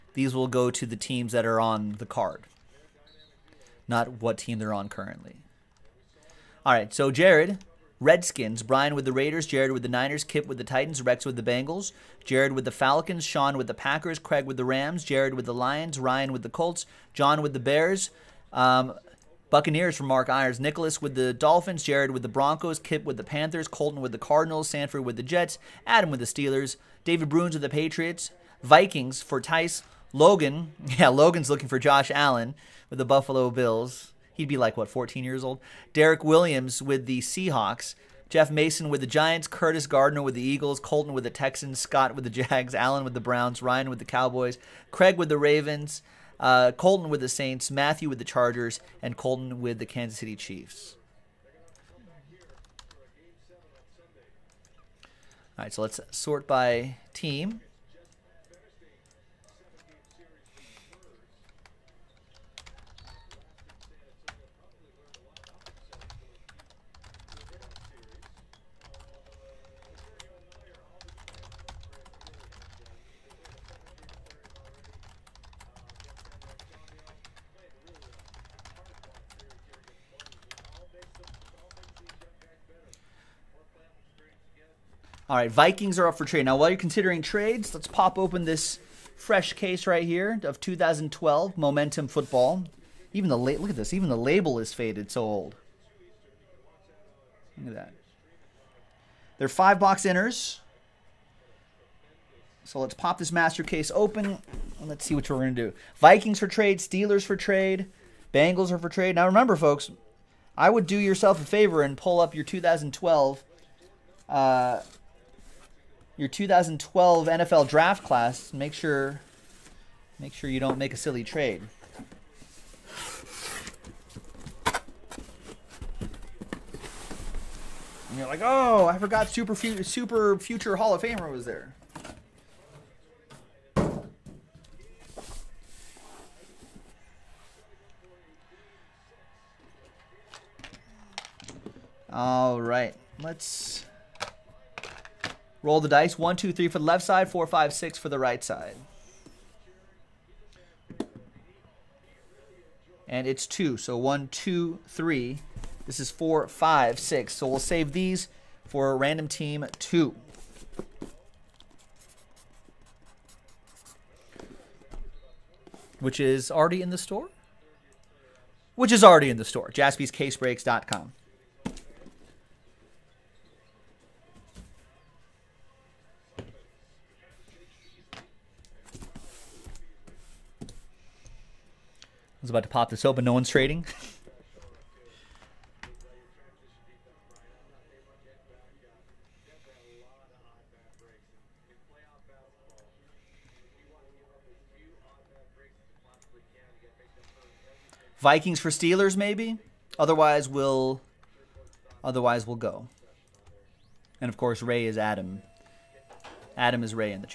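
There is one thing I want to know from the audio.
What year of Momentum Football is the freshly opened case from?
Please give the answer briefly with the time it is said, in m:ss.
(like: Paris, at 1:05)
2012, at 1:30.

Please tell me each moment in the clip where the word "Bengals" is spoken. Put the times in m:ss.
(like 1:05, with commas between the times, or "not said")
0:11, 1:48.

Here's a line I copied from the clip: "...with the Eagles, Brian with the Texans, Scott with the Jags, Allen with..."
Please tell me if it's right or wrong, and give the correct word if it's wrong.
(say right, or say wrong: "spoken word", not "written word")
wrong: "Colton", not "Brian".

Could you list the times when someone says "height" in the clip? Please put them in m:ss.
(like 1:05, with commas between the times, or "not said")
not said.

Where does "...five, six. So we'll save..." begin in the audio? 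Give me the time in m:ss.
2:36.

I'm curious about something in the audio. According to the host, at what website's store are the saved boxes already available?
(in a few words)
JaspysCaseBreaks.com.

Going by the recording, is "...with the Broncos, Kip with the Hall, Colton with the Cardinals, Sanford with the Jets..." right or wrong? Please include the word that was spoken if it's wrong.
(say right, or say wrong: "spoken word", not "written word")
wrong: "Panthers", not "Hall".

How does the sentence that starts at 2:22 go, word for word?
All right, let's Roll the dice.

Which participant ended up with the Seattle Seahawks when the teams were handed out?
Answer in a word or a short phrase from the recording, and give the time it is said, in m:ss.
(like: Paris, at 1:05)
Derek Williams, at 0:35.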